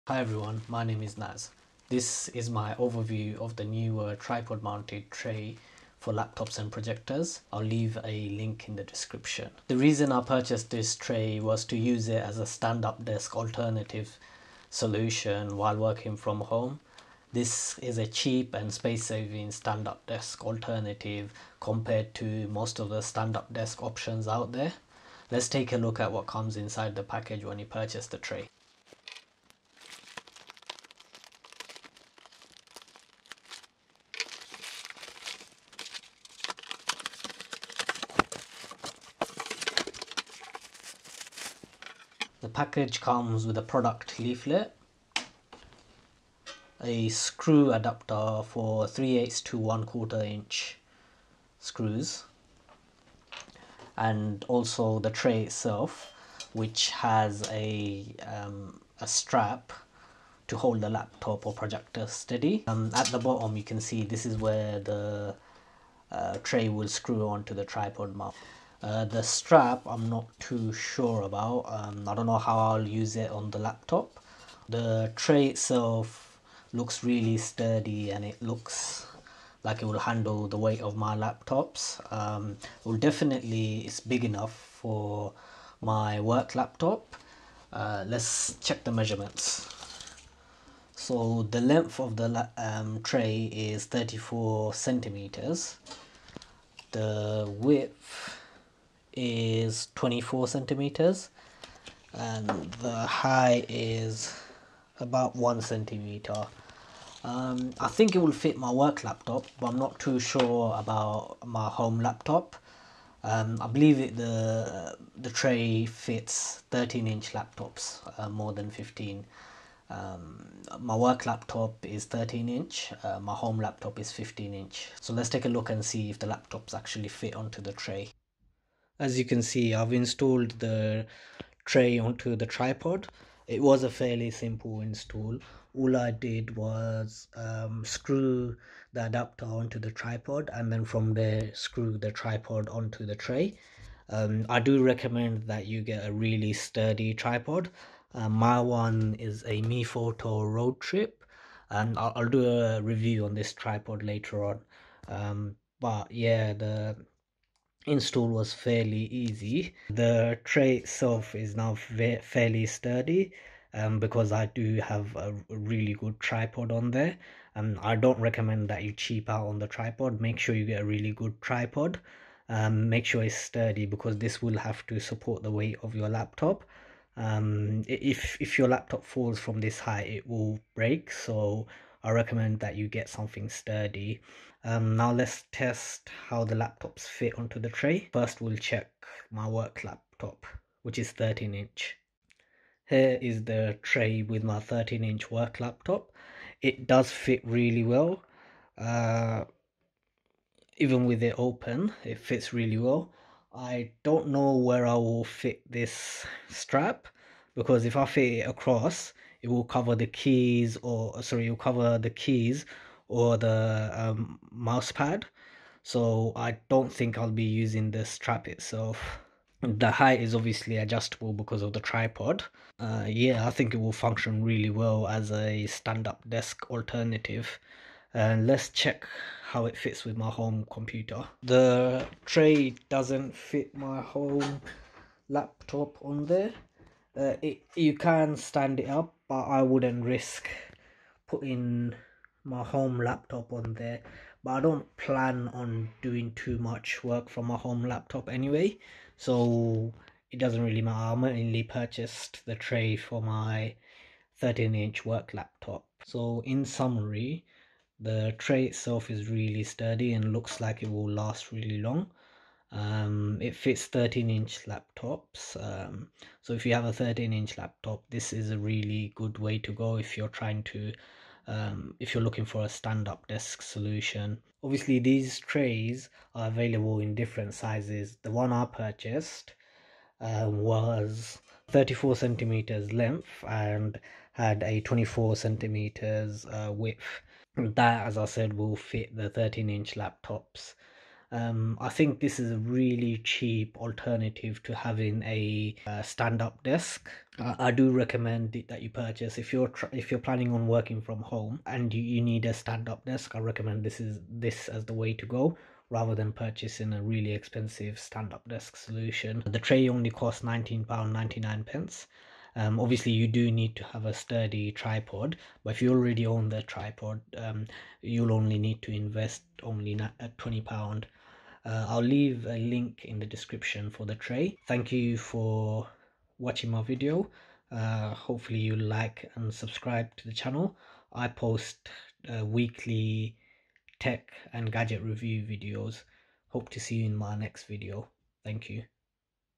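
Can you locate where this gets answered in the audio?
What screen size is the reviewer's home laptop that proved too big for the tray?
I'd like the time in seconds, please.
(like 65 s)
124 s.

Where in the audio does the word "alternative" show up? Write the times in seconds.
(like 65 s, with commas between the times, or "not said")
13 s, 20 s, 226 s, 293 s.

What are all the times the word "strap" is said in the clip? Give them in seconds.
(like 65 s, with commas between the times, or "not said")
59 s, 69 s, 206 s, 218 s.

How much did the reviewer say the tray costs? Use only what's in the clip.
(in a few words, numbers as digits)
£19.99.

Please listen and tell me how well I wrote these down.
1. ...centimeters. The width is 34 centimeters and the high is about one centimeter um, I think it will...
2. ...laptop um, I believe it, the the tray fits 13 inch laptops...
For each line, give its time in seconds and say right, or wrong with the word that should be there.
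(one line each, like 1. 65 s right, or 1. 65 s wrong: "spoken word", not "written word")
1. 94 s wrong: "24", not "34"
2. 111 s right.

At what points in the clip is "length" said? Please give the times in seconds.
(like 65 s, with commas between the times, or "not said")
91 s, 282 s.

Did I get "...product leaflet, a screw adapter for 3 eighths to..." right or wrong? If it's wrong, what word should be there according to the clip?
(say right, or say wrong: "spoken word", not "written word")
right.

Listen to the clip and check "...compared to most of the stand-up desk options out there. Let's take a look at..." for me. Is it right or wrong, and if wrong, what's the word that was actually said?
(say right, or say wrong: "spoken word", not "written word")
right.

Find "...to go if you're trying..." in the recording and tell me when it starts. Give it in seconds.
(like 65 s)
269 s.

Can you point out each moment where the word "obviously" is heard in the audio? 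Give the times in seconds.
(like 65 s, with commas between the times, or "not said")
220 s, 274 s, 312 s.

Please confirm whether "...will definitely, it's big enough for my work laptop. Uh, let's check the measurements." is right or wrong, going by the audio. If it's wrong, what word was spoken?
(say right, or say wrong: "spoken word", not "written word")
right.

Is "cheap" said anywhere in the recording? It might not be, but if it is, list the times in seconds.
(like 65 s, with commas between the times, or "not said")
18 s, 168 s, 293 s.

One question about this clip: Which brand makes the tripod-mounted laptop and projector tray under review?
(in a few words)
Neewer.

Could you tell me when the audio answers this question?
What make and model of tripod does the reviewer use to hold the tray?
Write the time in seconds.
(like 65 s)
149 s.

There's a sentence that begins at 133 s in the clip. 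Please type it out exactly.
It was a fairly simple install.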